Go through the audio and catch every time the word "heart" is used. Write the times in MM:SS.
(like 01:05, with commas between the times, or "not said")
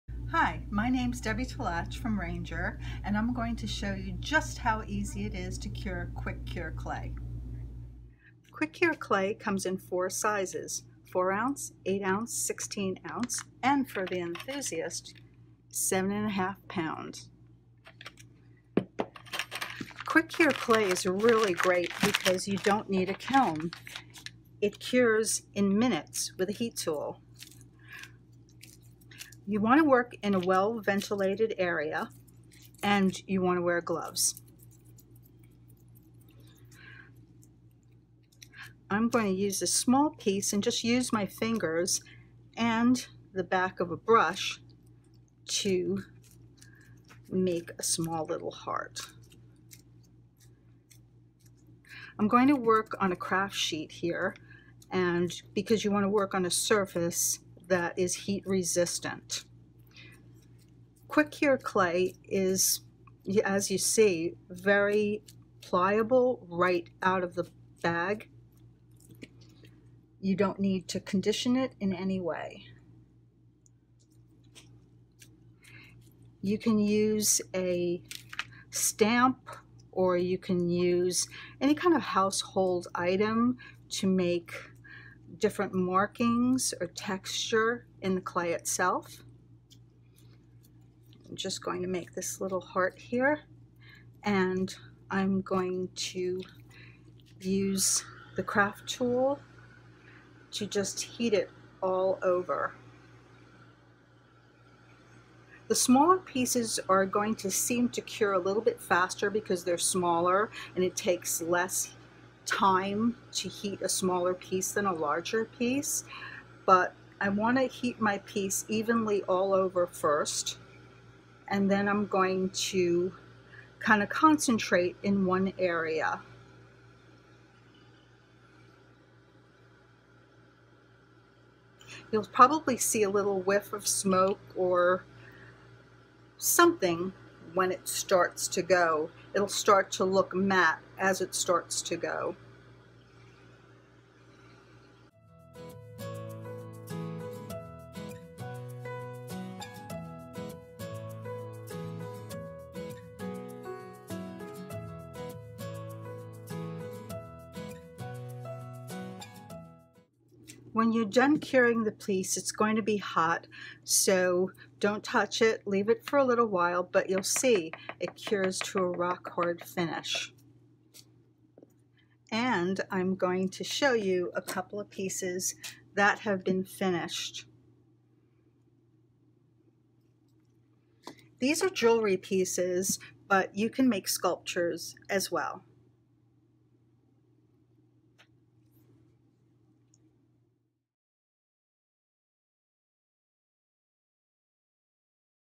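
00:48, 01:32.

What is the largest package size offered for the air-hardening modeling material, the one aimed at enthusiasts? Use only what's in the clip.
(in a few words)
7.5 pounds.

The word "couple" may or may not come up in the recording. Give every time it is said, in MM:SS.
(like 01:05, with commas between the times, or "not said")
02:54.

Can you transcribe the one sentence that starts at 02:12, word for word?
You'll probably see a little whiff of smoke or something when it starts to go.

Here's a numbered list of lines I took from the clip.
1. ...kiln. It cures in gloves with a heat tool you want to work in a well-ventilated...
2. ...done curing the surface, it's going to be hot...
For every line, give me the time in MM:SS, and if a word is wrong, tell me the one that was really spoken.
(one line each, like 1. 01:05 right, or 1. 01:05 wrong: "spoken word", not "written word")
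1. 00:23 wrong: "minutes", not "gloves"
2. 02:41 wrong: "piece", not "surface".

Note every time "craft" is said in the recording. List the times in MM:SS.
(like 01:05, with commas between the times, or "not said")
00:53, 01:38.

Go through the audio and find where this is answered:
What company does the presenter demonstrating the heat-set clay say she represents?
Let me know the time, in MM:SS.
00:02.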